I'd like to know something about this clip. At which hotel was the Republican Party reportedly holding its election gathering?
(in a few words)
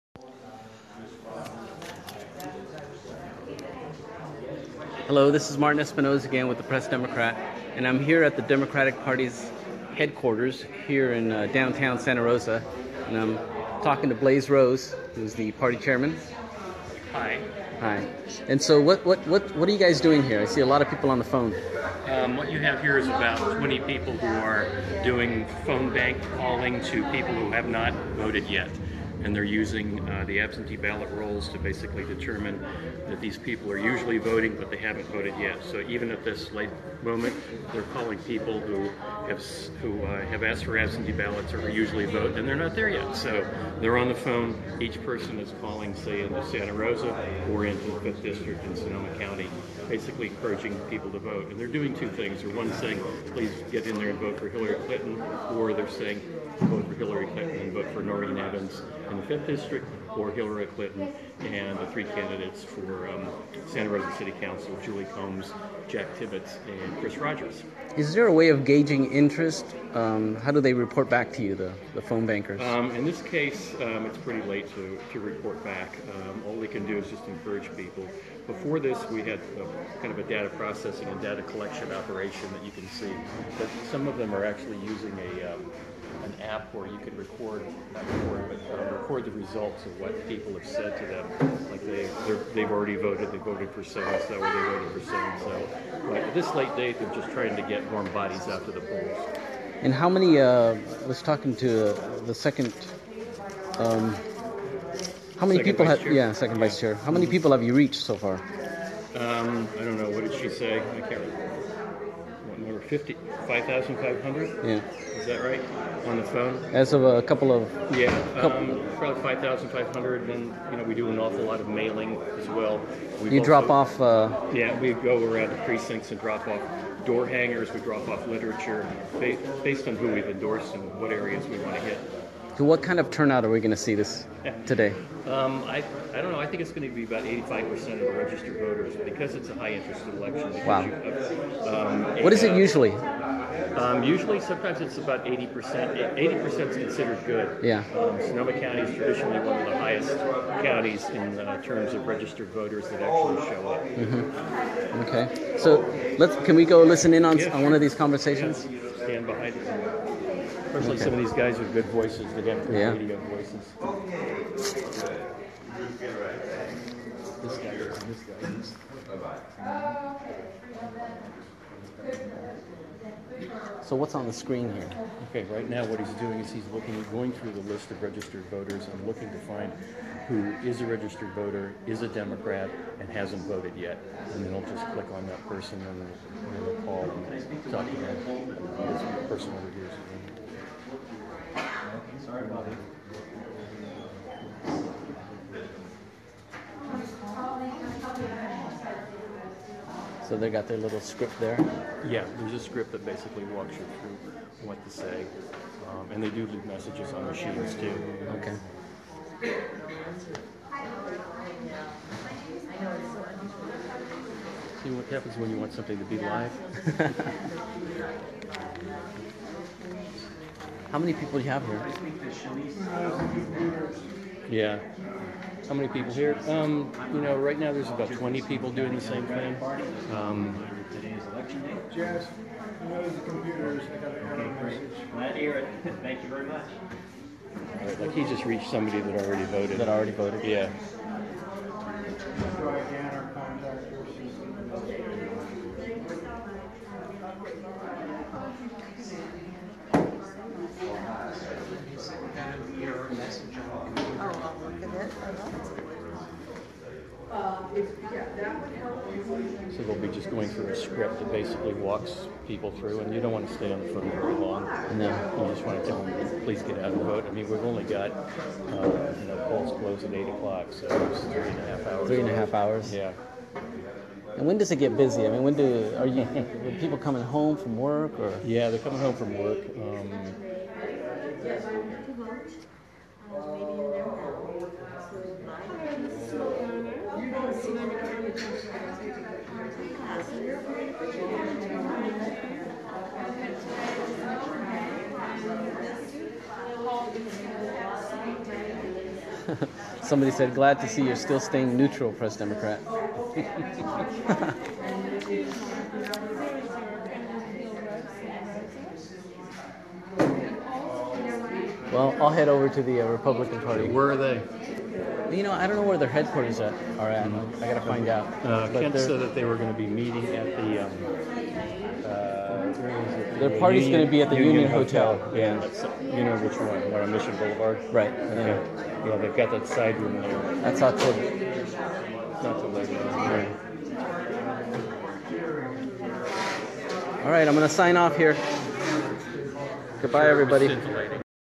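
Union Hotel.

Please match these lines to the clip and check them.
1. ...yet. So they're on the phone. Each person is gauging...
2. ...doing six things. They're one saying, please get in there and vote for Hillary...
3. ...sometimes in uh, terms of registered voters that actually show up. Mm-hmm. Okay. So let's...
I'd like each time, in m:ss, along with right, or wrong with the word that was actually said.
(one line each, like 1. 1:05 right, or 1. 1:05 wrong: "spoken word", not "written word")
1. 0:42 wrong: "calling", not "gauging"
2. 0:51 wrong: "two", not "six"
3. 2:30 wrong: "counties", not "sometimes".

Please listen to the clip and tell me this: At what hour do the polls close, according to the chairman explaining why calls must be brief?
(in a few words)
8 o'clock.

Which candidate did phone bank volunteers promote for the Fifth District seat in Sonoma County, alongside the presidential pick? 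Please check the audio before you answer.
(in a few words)
Noreen Evans.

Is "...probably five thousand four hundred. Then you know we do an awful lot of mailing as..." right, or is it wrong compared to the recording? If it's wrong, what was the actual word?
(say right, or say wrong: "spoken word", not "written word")
wrong: "five", not "four".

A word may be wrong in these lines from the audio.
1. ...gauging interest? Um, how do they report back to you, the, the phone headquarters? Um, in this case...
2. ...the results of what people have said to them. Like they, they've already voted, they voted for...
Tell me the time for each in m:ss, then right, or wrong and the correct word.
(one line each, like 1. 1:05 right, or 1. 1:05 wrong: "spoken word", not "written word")
1. 1:08 wrong: "bankers", not "headquarters"
2. 1:29 right.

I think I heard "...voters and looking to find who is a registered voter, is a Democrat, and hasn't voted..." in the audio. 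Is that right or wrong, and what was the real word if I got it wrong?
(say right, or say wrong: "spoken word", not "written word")
right.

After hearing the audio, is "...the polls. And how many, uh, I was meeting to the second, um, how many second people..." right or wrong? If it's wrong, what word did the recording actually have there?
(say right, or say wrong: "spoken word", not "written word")
wrong: "talking", not "meeting".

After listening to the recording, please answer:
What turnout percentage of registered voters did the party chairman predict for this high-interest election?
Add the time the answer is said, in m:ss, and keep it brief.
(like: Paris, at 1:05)
85%, at 2:17.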